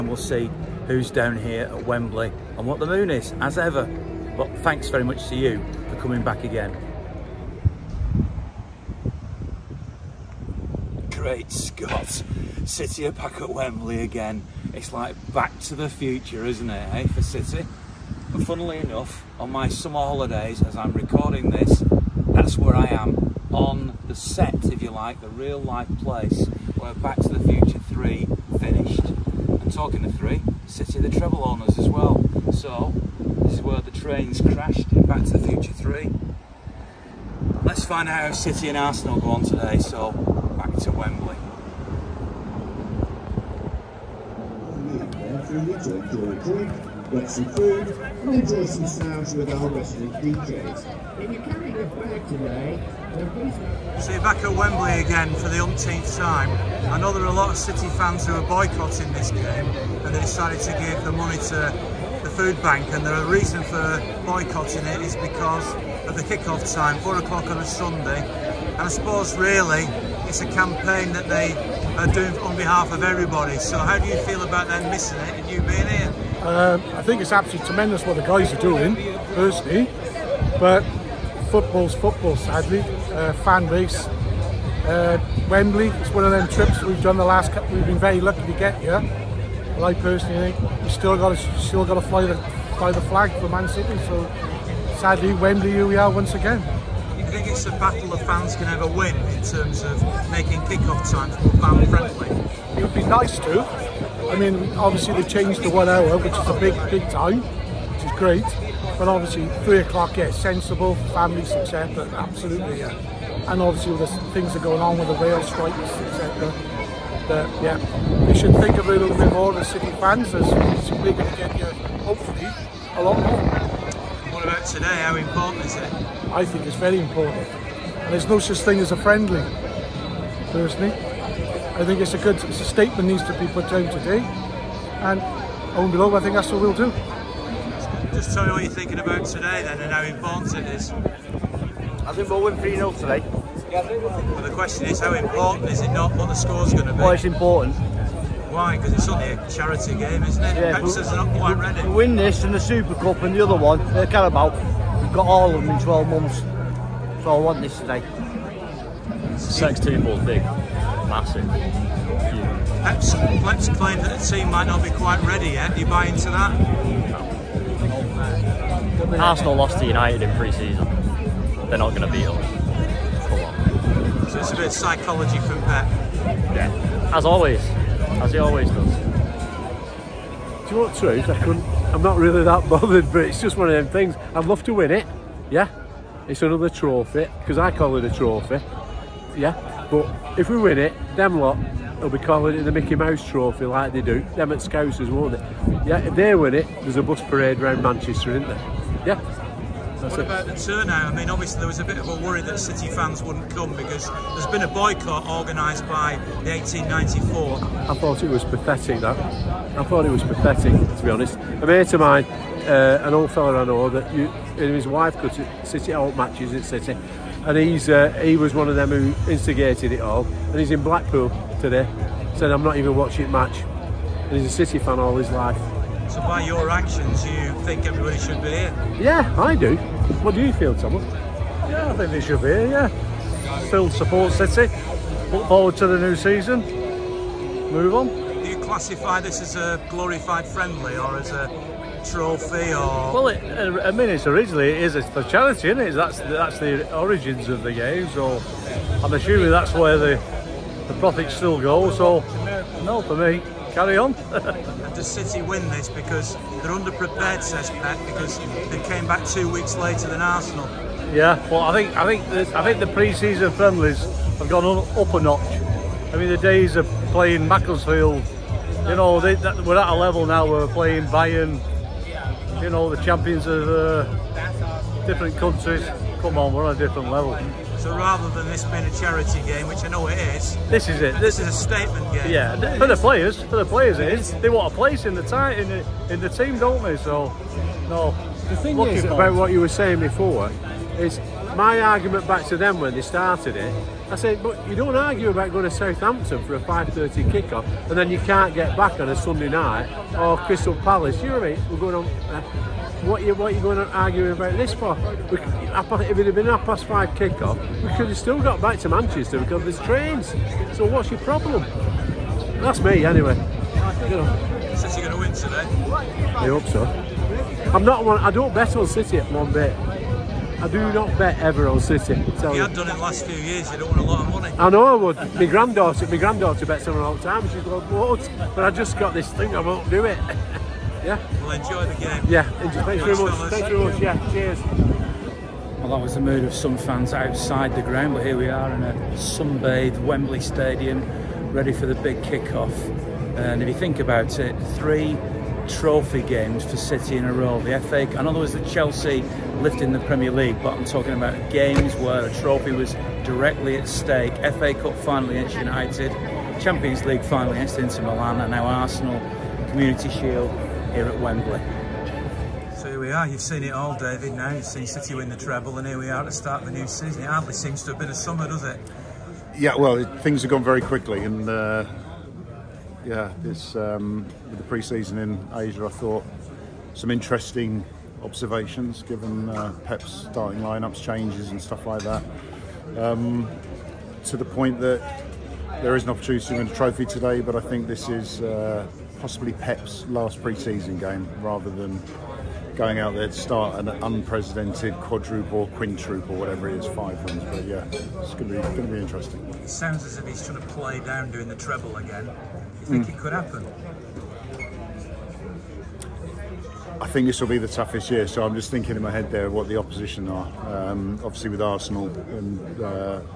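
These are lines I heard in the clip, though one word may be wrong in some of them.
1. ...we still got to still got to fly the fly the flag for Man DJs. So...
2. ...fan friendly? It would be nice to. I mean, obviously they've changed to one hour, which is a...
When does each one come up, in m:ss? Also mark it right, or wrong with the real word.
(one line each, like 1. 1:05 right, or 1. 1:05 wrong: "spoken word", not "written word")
1. 1:30 wrong: "City", not "DJs"
2. 1:41 right.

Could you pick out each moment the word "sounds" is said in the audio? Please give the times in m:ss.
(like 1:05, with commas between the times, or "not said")
0:48, 6:39.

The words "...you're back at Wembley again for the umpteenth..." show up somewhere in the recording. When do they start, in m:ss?
0:54.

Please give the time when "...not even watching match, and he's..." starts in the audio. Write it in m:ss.
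3:42.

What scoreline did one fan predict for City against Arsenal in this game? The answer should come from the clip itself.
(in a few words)
3-0.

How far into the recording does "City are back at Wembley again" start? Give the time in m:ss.
0:12.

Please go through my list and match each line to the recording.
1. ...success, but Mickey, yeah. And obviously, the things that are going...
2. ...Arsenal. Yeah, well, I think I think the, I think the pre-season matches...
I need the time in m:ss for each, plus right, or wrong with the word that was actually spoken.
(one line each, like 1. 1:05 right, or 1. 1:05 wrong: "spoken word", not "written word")
1. 1:51 wrong: "Absolutely", not "Mickey"
2. 4:20 wrong: "friendlies", not "matches".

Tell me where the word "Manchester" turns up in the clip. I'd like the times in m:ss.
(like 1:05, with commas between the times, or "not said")
3:17, 5:08.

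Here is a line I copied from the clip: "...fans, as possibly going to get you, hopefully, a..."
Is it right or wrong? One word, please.
wrong.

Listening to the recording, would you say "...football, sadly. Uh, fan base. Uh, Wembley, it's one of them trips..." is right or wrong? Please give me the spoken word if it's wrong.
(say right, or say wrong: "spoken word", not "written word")
right.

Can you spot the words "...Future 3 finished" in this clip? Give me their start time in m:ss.
0:27.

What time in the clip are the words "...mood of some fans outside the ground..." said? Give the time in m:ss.
5:36.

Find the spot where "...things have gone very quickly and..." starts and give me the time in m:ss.
6:10.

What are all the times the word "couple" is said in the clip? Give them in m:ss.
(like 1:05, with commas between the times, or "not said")
1:27.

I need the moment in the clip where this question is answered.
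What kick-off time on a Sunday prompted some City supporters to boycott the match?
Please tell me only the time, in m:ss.
1:07.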